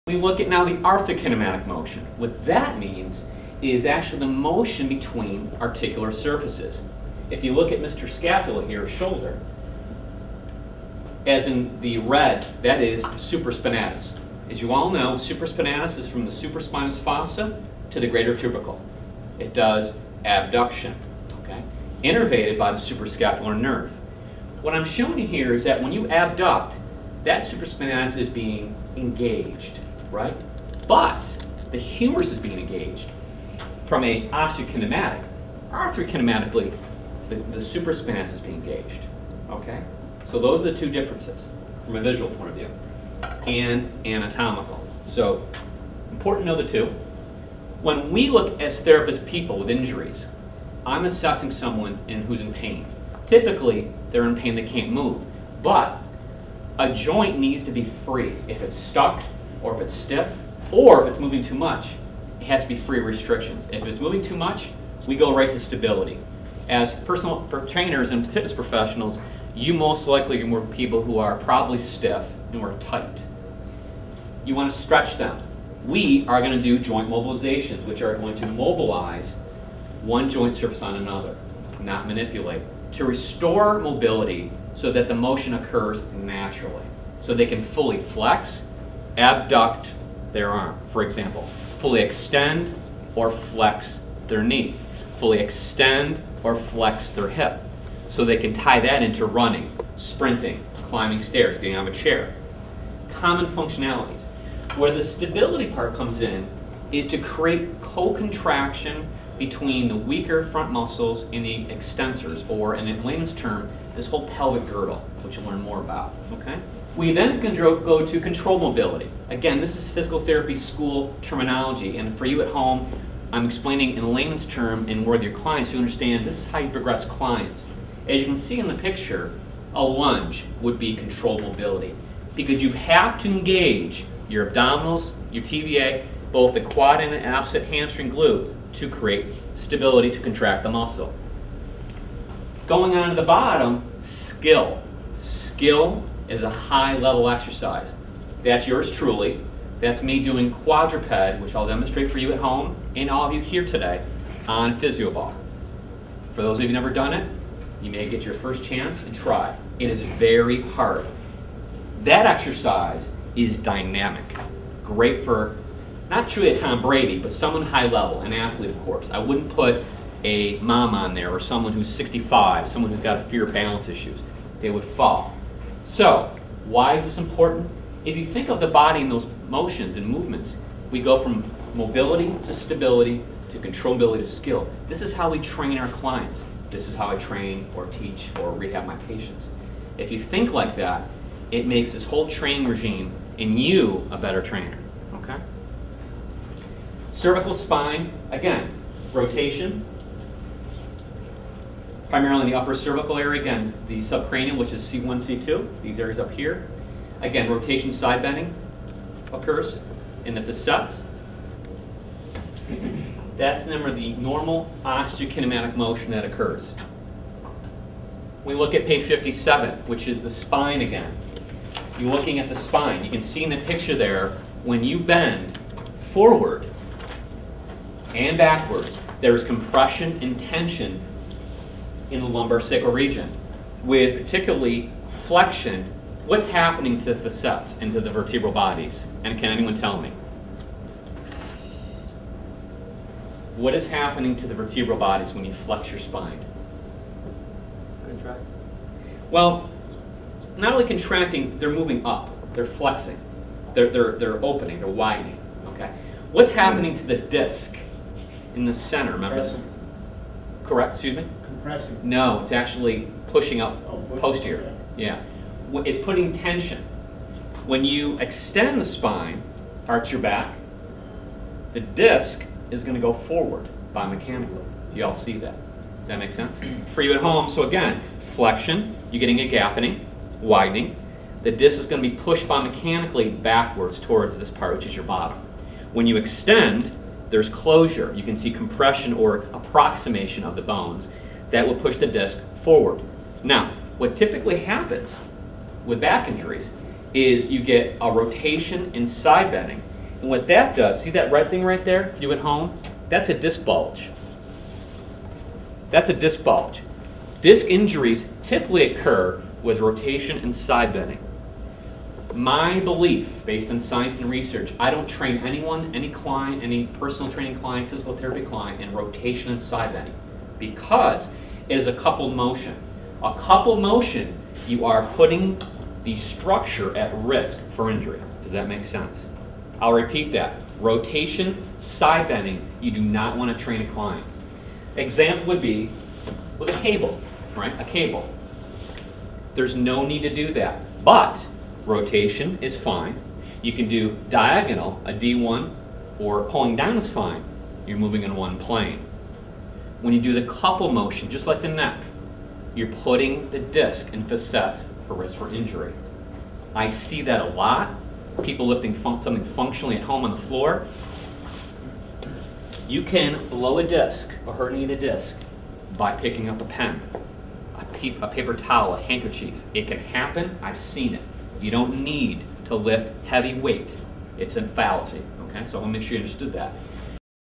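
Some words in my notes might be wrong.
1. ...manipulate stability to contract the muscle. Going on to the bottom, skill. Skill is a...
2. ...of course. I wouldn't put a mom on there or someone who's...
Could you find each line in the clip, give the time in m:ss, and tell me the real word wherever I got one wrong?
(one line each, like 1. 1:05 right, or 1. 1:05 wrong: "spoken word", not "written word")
1. 2:18 wrong: "create", not "manipulate"
2. 2:48 right.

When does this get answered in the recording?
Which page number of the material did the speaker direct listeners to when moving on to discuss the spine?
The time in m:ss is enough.
3:38.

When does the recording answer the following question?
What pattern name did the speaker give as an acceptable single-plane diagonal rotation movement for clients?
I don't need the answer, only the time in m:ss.
5:45.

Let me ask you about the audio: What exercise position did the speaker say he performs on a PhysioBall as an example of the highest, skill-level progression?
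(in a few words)
Quadruped.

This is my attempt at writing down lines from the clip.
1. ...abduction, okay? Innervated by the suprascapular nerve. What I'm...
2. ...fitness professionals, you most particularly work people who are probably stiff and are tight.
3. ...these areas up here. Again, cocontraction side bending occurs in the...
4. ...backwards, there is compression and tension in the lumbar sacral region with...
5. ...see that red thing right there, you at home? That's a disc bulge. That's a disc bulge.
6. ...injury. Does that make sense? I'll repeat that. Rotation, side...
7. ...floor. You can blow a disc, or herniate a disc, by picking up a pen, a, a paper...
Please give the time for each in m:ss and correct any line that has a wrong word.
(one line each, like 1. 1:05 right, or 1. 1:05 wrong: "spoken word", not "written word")
1. 0:20 right
2. 1:08 wrong: "likely", not "particularly"
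3. 3:25 wrong: "rotation", not "cocontraction"
4. 3:48 right
5. 5:01 right
6. 5:27 right
7. 6:00 right.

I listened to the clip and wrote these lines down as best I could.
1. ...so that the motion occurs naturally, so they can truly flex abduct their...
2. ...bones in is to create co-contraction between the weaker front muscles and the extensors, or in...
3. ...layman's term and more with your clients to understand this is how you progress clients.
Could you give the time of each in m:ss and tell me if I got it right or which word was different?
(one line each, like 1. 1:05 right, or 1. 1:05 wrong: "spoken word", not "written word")
1. 1:24 wrong: "fully", not "truly"
2. 1:45 wrong: "comes", not "bones"
3. 2:04 right.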